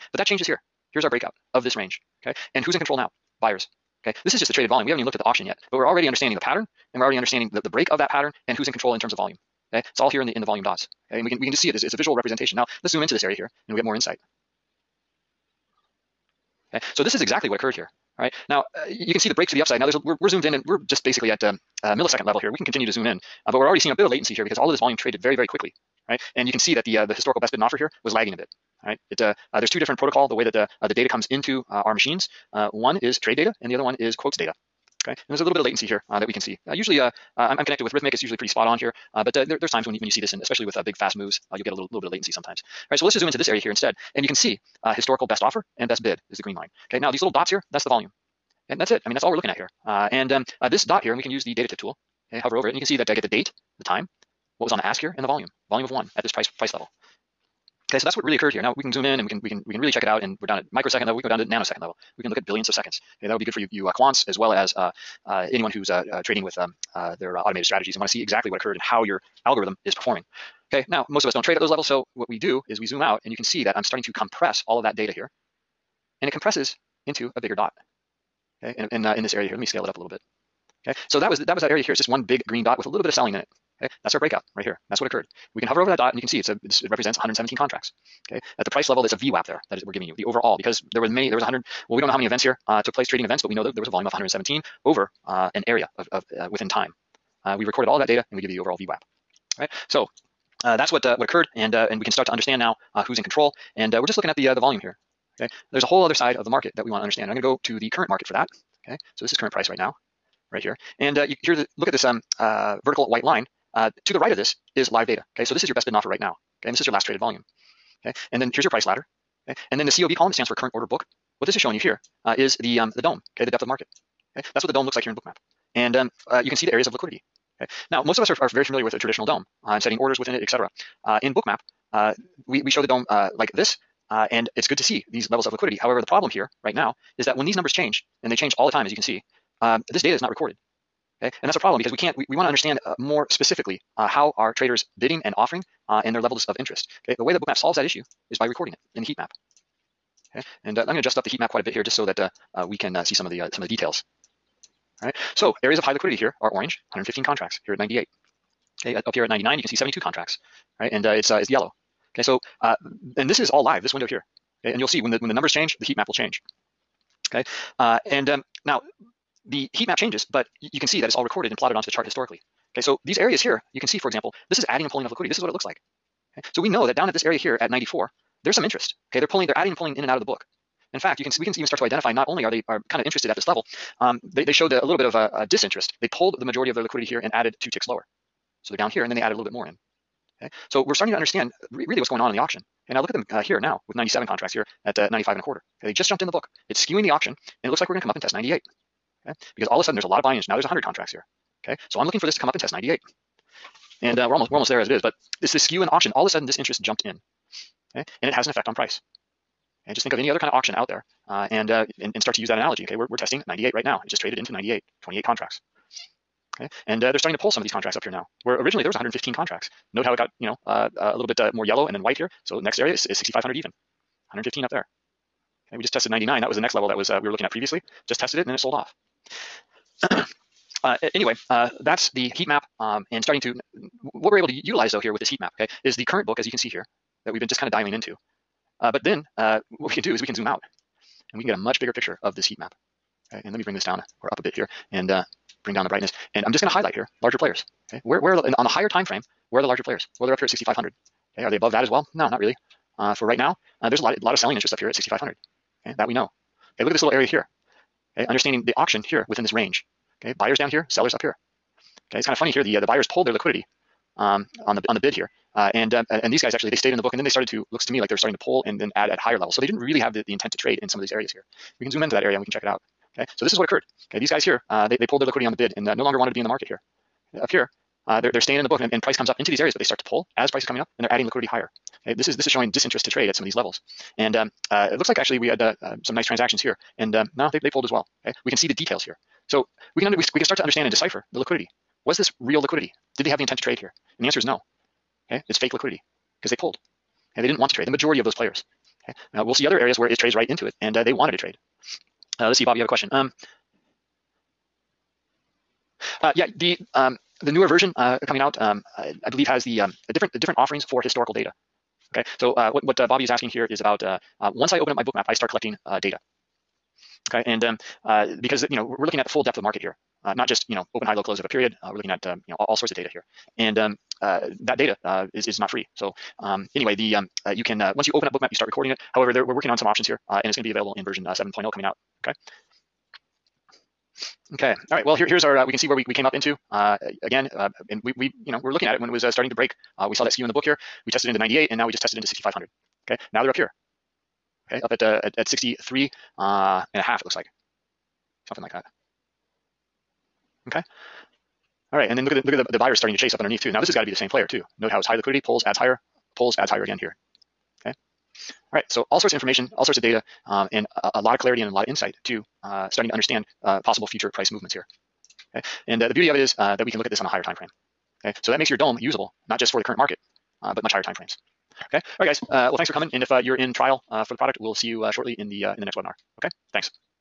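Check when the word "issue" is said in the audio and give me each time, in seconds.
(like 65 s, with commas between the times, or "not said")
147 s.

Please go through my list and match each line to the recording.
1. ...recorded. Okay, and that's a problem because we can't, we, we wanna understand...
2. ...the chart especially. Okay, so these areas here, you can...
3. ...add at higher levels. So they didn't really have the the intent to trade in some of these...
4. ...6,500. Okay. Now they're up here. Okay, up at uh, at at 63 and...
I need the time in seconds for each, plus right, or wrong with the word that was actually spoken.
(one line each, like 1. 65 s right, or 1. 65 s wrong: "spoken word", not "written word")
1. 140 s right
2. 171 s wrong: "historically", not "especially"
3. 268 s right
4. 342 s right.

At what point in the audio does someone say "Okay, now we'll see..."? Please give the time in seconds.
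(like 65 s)
299 s.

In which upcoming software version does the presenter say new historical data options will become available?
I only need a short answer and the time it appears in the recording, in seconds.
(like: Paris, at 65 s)
7.0, at 331 s.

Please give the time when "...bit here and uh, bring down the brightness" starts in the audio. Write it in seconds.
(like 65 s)
244 s.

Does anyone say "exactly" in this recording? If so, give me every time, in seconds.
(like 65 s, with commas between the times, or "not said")
17 s, 68 s.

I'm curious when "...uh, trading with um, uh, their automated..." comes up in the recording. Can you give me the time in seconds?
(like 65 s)
66 s.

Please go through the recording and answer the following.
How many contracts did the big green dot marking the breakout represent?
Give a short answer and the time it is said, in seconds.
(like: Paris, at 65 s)
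117, at 87 s.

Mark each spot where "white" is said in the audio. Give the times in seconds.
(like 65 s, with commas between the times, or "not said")
113 s, 222 s.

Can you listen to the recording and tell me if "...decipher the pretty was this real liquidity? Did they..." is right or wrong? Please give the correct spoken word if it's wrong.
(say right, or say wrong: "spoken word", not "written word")
wrong: "liquidity", not "pretty".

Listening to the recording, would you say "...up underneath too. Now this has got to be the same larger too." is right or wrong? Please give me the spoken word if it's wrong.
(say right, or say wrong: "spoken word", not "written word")
wrong: "player", not "larger".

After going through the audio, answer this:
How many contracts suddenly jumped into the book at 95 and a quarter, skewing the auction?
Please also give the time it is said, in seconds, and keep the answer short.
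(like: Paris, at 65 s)
97, at 193 s.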